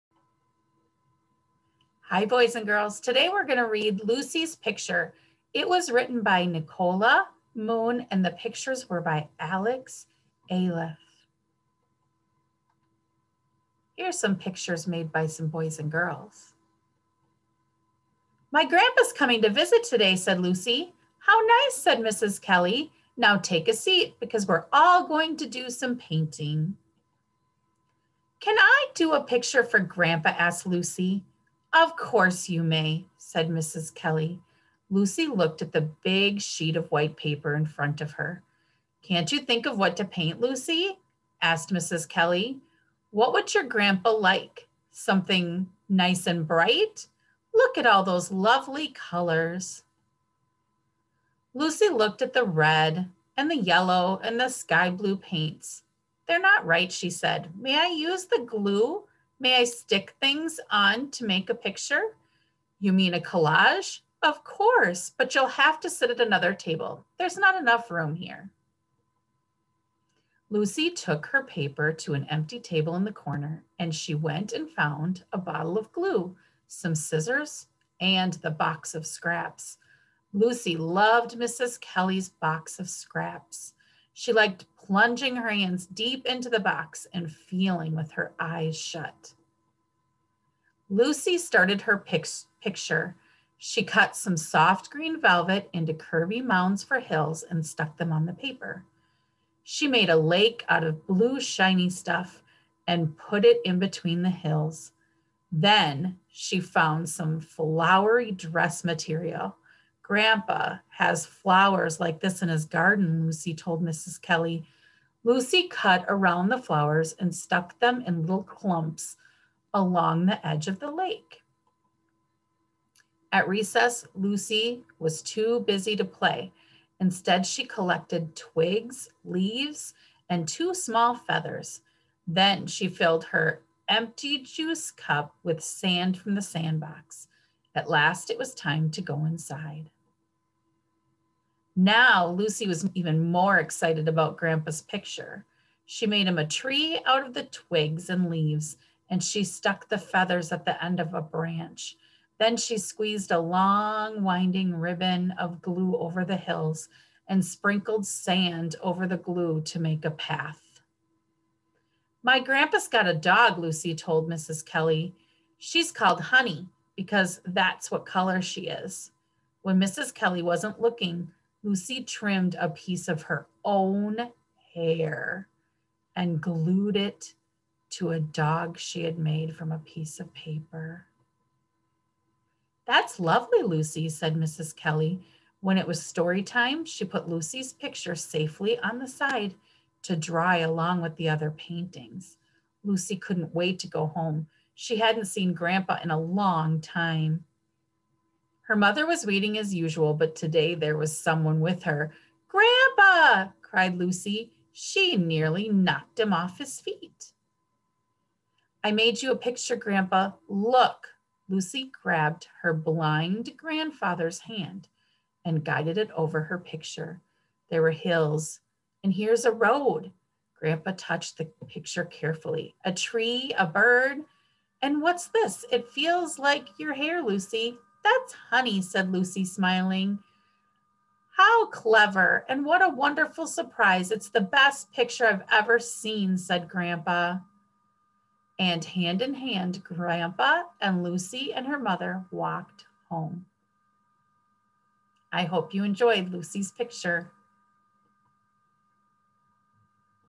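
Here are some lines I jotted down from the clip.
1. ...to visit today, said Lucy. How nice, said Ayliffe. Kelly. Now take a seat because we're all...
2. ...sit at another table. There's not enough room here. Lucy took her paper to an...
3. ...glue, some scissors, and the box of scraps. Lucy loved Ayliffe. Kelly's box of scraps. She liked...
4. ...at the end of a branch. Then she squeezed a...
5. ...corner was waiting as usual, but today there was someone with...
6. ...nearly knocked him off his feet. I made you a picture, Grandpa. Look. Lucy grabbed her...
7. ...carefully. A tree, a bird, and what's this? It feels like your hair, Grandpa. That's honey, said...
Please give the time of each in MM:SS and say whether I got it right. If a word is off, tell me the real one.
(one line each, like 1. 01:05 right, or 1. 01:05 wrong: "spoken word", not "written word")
1. 00:19 wrong: "Mrs", not "Ayliffe"
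2. 01:05 right
3. 01:15 wrong: "Mrs", not "Ayliffe"
4. 02:30 right
5. 03:18 wrong: "mother", not "corner"
6. 03:25 right
7. 03:42 wrong: "Lucy", not "Grandpa".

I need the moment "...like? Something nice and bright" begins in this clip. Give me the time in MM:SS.
00:44.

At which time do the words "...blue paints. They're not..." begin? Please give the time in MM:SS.
00:54.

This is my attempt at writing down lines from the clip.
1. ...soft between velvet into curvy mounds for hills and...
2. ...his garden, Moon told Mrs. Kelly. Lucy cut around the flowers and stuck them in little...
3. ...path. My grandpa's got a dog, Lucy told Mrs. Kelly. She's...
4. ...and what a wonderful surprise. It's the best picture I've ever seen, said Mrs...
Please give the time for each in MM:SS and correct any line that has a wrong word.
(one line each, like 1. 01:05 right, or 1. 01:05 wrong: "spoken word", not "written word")
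1. 01:34 wrong: "green", not "between"
2. 01:52 wrong: "Lucy", not "Moon"
3. 02:40 right
4. 03:52 wrong: "Grandpa", not "Mrs".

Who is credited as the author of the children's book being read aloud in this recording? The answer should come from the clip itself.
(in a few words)
Nicola Moon.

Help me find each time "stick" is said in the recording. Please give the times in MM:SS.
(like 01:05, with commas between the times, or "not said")
00:59.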